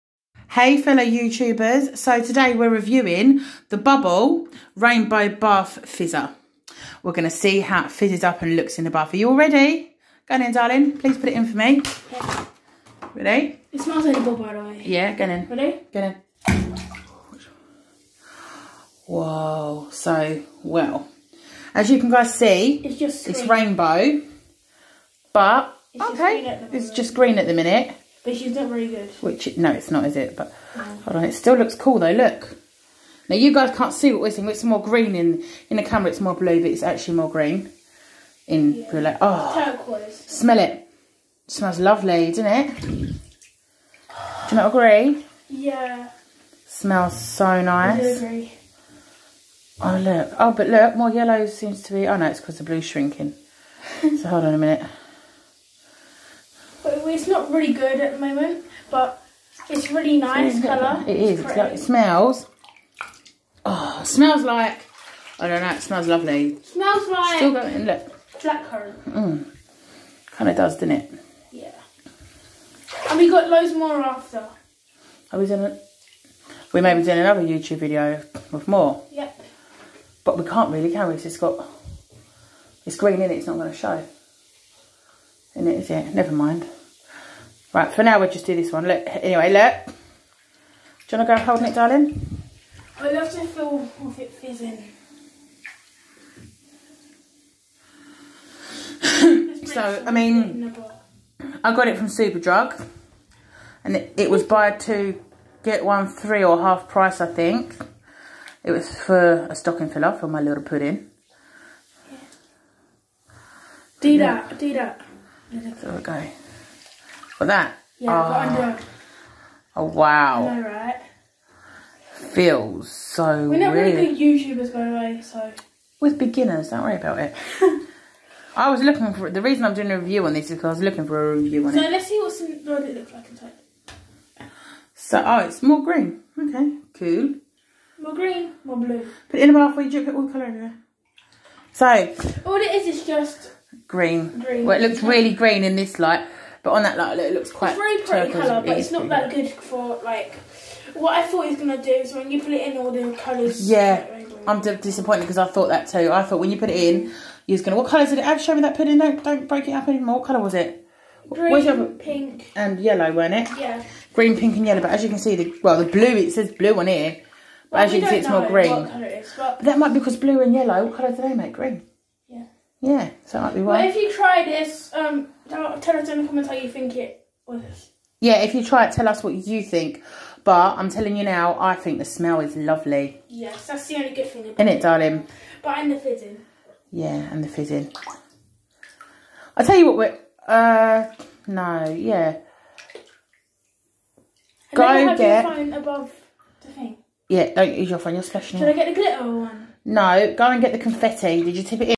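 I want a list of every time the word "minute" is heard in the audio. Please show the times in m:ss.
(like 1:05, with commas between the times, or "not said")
0:27, 0:54.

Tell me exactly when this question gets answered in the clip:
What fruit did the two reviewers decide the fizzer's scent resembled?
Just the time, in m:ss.
1:08.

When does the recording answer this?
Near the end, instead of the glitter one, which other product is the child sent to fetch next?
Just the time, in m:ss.
3:20.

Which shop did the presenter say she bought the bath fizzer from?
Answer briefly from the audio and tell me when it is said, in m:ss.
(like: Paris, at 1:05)
Superdrug, at 1:42.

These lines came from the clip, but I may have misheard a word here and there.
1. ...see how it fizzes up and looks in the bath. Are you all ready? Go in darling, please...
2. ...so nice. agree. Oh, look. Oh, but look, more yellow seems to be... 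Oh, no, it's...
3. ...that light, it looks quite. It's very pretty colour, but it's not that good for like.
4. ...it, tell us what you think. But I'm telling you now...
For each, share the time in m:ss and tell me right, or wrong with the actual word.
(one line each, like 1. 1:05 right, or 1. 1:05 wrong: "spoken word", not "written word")
1. 0:07 right
2. 0:47 right
3. 2:26 right
4. 2:58 right.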